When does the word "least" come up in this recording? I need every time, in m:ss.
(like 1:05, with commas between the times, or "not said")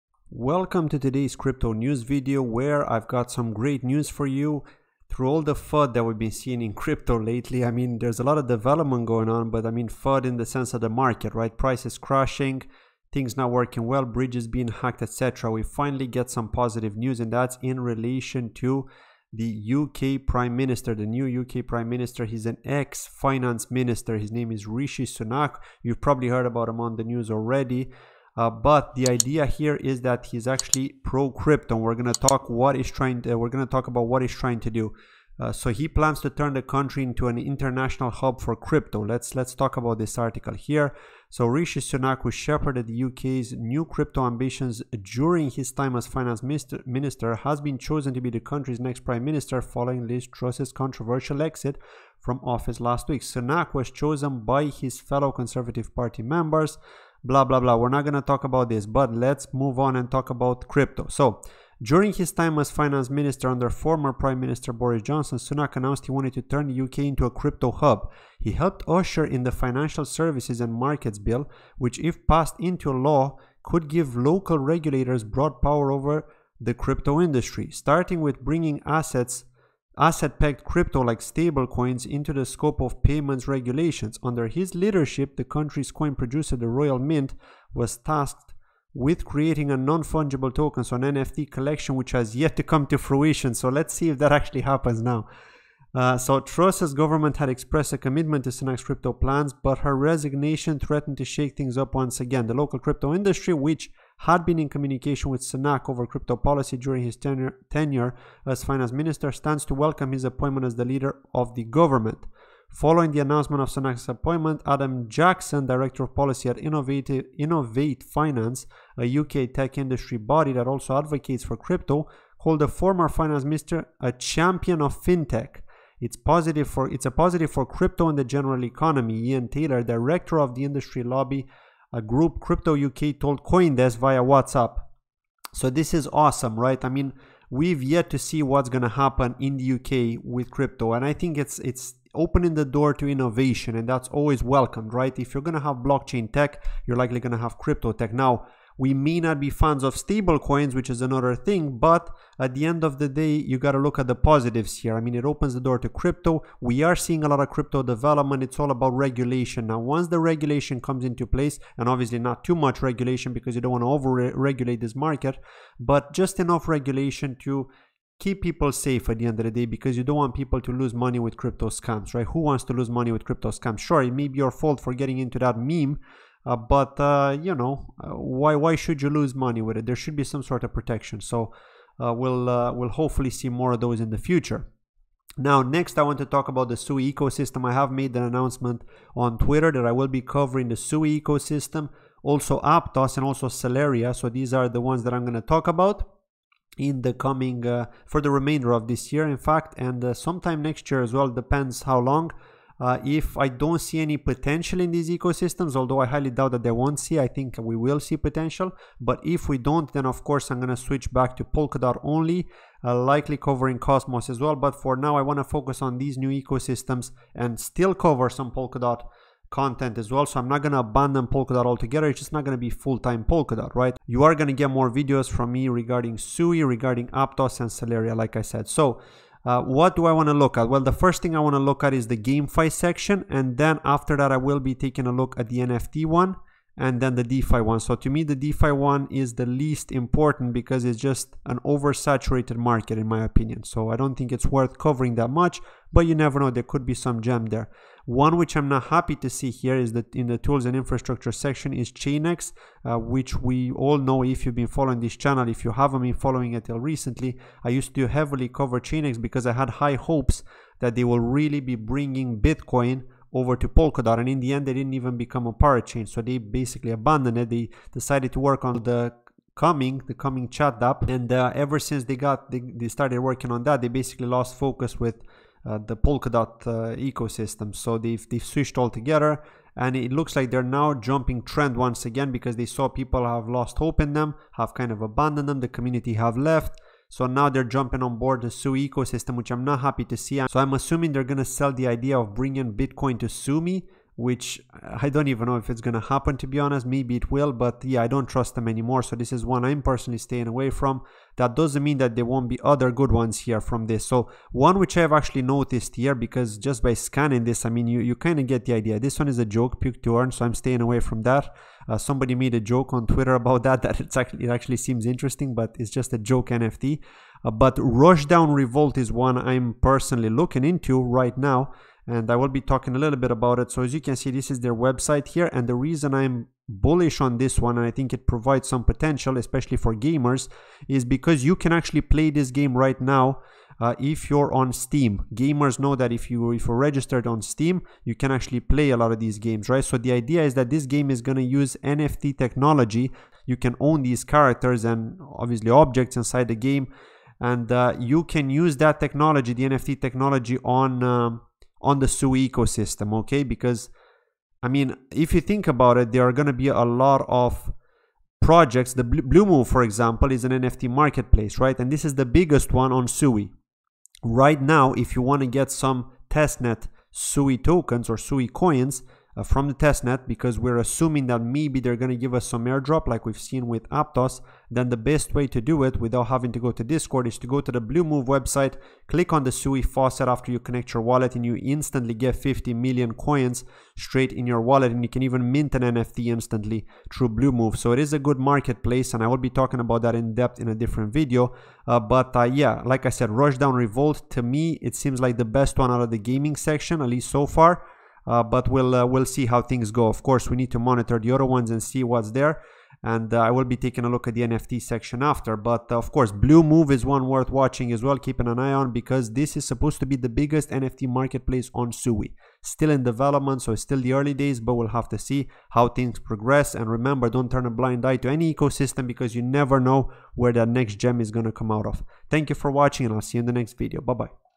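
3:59, 6:37.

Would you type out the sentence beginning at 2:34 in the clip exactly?
I mean, it opens the door to crypto.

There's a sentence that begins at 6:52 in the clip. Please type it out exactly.
Still in development, so it's still the early days, but we'll have to see how things progress.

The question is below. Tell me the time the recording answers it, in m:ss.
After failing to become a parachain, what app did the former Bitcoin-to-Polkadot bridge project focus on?
4:30.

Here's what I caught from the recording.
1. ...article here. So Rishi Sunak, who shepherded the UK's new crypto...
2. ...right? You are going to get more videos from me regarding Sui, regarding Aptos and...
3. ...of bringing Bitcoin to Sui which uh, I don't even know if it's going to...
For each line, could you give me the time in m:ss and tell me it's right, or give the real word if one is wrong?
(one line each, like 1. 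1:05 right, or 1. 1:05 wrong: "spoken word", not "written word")
1. 0:40 right
2. 3:43 right
3. 4:52 right.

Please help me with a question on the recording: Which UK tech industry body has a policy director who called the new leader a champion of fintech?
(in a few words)
Innovate Finance.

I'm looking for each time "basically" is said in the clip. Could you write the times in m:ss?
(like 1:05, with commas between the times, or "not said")
4:26, 4:33.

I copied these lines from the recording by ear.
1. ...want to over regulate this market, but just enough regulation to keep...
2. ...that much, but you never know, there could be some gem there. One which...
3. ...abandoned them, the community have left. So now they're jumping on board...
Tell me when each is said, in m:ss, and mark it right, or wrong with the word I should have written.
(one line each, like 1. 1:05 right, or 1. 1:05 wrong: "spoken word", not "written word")
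1. 2:43 right
2. 4:05 right
3. 4:45 right.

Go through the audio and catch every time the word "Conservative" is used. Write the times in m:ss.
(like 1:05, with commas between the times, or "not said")
0:55.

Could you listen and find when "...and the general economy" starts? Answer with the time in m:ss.
2:08.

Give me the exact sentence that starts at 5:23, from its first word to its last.
So as you can see, this is their website here.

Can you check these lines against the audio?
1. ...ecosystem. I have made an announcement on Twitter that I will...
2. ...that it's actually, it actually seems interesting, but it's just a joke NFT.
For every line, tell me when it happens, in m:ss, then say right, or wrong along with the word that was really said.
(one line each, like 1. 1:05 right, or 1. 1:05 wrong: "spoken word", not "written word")
1. 3:07 right
2. 5:13 right.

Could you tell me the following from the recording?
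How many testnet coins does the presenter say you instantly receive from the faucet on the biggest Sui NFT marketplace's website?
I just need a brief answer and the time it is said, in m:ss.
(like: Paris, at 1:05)
50 million, at 6:22.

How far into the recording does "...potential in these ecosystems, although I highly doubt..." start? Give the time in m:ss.
3:24.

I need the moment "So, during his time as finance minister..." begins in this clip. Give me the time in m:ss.
1:01.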